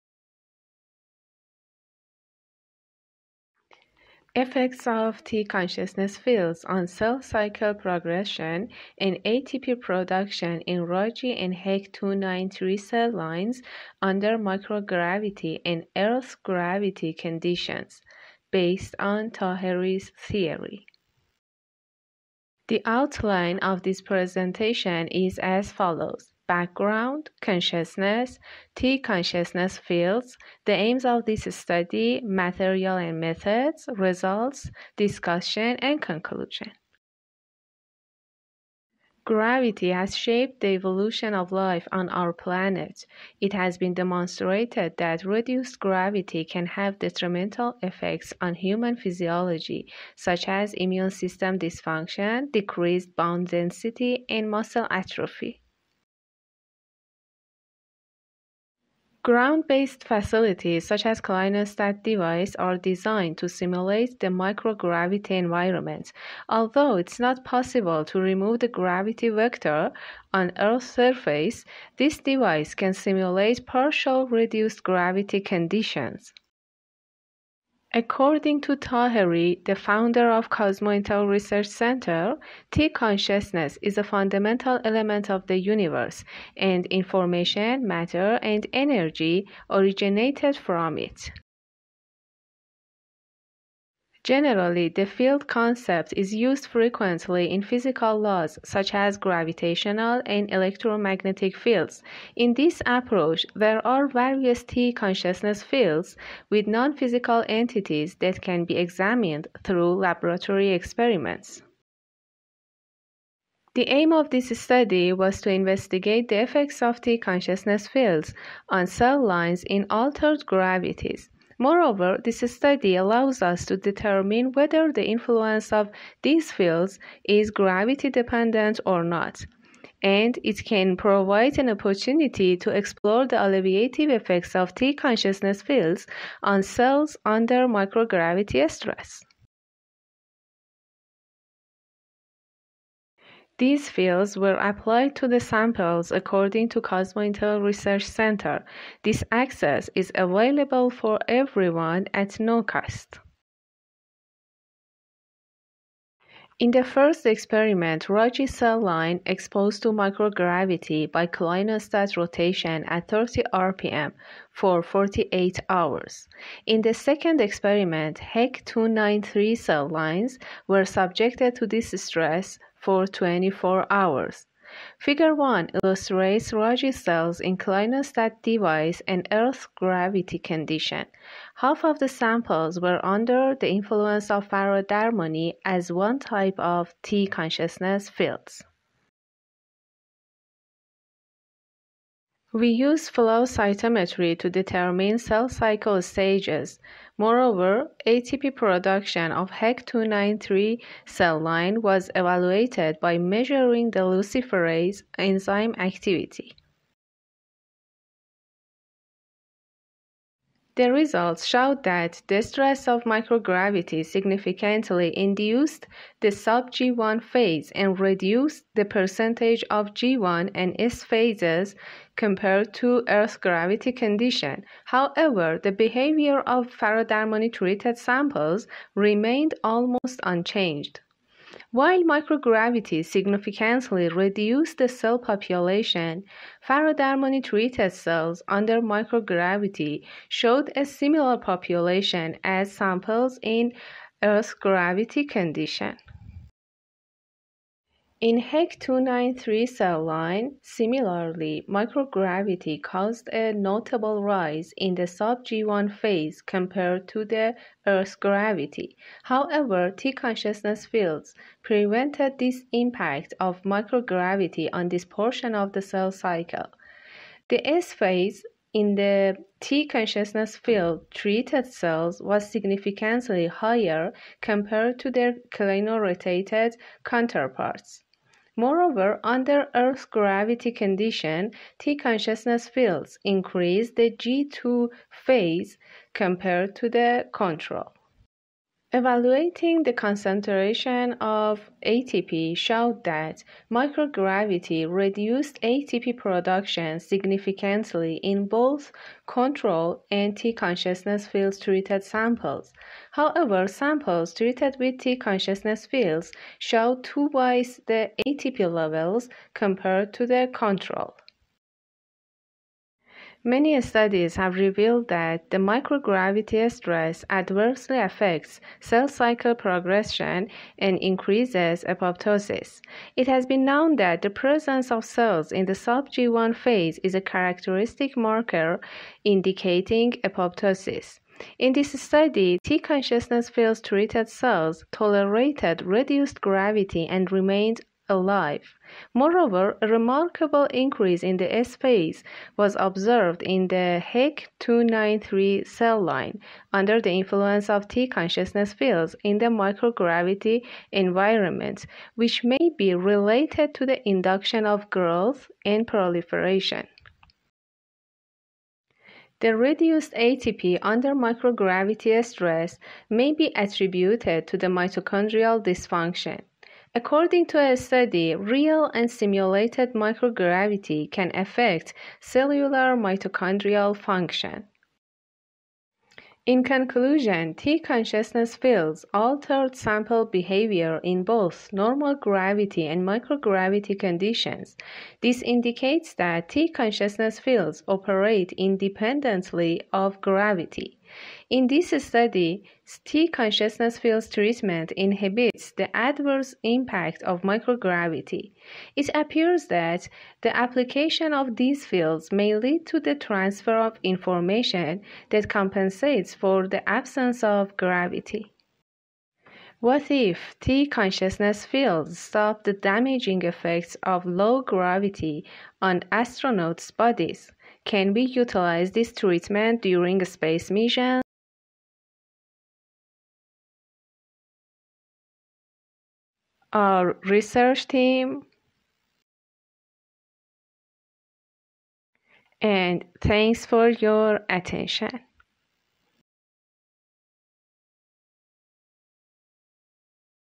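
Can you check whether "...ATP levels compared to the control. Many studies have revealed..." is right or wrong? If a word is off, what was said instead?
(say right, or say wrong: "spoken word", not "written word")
right.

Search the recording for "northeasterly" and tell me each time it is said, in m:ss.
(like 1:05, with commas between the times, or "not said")
not said.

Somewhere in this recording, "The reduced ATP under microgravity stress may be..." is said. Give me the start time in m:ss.
5:59.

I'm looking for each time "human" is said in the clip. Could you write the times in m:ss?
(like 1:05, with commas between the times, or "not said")
0:48.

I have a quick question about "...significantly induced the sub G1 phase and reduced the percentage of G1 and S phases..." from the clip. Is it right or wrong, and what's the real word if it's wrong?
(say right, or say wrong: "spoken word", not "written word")
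right.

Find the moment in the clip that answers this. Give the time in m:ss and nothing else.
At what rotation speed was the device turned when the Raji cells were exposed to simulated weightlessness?
2:43.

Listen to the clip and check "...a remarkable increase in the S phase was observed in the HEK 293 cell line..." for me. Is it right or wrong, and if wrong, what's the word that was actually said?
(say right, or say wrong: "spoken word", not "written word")
right.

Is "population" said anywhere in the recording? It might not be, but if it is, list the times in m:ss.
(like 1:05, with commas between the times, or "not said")
3:55, 4:01.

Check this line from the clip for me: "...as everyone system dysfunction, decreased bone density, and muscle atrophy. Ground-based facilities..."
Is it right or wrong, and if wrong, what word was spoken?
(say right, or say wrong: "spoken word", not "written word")
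wrong: "immune", not "everyone".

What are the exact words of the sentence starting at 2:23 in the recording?
These fields were applied to the samples according to Cosmointel Research Center.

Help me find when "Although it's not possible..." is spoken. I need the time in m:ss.
1:06.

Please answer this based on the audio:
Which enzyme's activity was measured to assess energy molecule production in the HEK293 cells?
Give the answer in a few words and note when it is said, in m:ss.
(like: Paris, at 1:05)
luciferase, at 3:24.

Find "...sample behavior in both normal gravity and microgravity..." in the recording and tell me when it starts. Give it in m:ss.
6:19.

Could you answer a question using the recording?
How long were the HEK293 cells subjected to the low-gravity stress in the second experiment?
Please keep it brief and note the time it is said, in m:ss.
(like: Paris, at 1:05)
24 hours, at 2:53.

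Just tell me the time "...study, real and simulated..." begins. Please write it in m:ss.
6:07.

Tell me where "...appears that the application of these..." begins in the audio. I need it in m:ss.
6:39.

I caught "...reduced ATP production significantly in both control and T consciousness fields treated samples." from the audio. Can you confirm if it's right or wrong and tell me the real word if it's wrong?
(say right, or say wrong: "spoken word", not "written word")
right.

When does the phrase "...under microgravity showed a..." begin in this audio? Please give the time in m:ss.
3:58.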